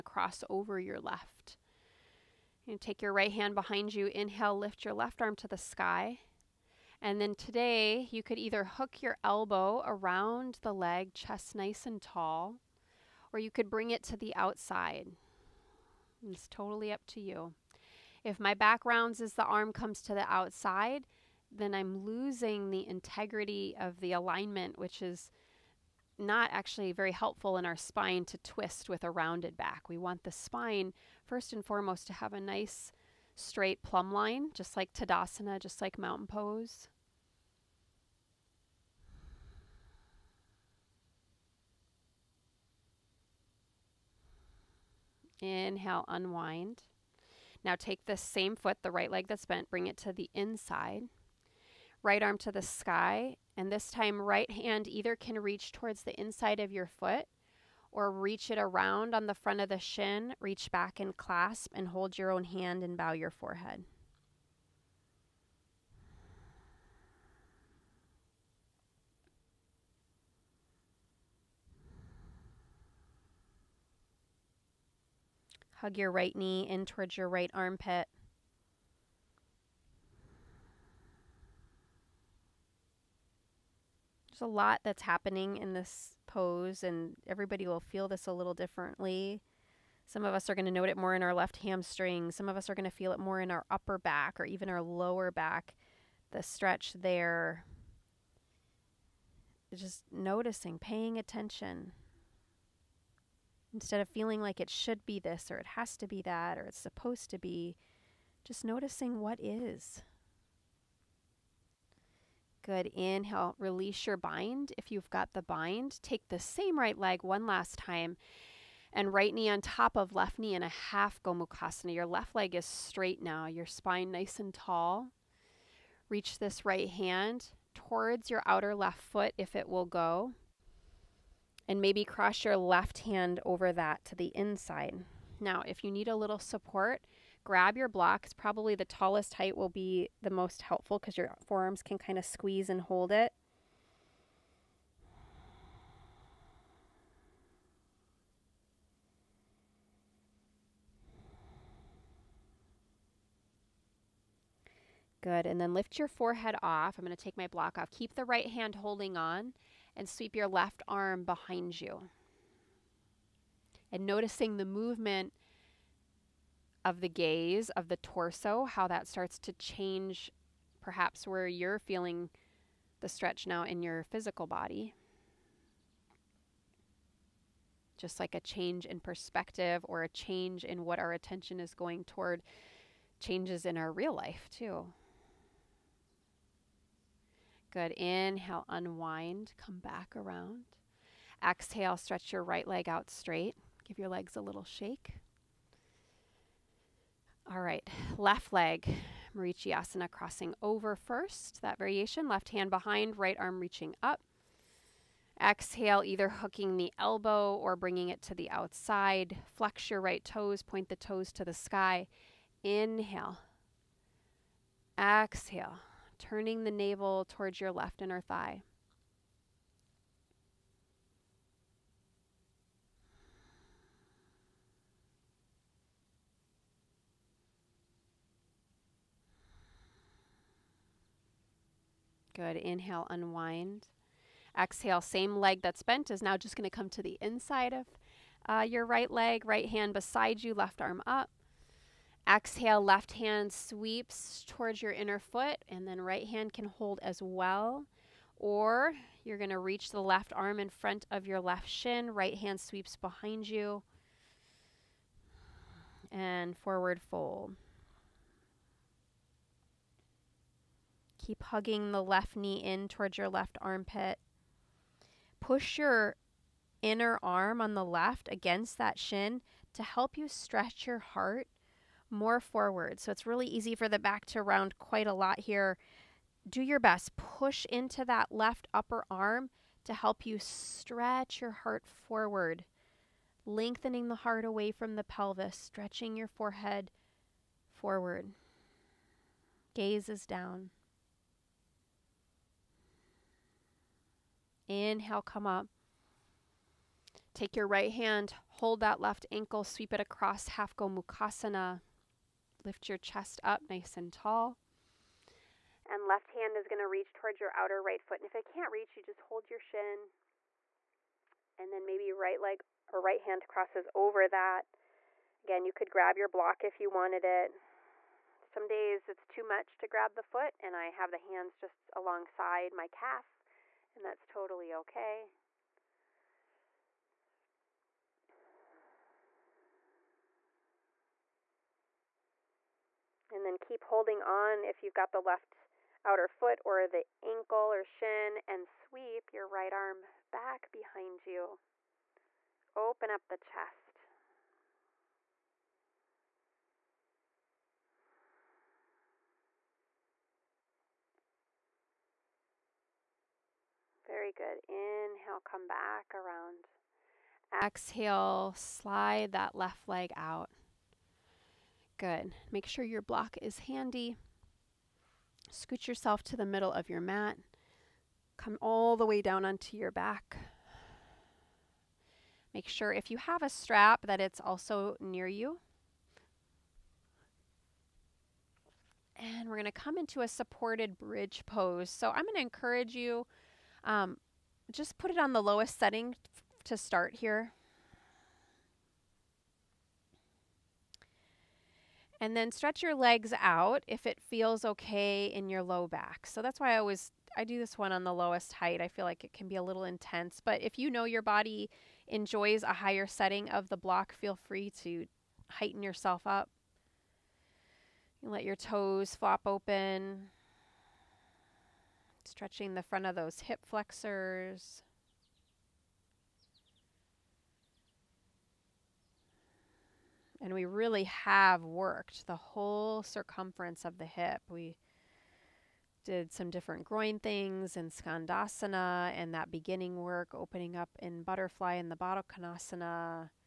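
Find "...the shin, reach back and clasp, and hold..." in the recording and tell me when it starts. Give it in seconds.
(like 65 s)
59 s.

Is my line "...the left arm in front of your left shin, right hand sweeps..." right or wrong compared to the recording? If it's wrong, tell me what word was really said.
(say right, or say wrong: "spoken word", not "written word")
right.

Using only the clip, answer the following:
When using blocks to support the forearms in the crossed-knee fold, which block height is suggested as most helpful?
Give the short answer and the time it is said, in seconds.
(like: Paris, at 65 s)
The tallest height, at 138 s.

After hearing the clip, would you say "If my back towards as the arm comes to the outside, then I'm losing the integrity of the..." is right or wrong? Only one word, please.
wrong.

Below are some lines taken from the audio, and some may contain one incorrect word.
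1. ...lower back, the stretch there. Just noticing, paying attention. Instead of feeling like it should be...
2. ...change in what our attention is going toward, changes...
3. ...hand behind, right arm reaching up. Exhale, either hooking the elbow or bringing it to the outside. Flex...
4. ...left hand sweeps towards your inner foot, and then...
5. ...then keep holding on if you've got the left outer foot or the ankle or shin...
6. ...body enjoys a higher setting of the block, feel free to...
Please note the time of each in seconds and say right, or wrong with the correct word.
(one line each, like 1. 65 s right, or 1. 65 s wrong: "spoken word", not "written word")
1. 94 s right
2. 180 s right
3. 202 s right
4. 242 s right
5. 333 s right
6. 401 s right.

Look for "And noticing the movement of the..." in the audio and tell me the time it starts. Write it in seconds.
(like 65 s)
163 s.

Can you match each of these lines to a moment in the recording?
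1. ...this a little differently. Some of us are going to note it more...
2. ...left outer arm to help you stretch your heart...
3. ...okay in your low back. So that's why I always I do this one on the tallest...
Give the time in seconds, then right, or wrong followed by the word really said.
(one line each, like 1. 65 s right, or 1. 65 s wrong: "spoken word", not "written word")
1. 88 s right
2. 278 s wrong: "upper", not "outer"
3. 394 s wrong: "lowest", not "tallest".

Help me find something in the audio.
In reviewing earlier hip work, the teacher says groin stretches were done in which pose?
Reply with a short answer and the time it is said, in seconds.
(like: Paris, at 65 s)
Skandasana, at 427 s.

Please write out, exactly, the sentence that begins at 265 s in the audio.
Push your inner arm on the left against that shin to help you stretch your heart more forward.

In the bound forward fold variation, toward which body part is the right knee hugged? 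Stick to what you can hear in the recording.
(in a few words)
Right armpit.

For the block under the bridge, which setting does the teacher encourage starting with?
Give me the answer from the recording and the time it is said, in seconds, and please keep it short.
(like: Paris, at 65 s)
The lowest setting, at 385 s.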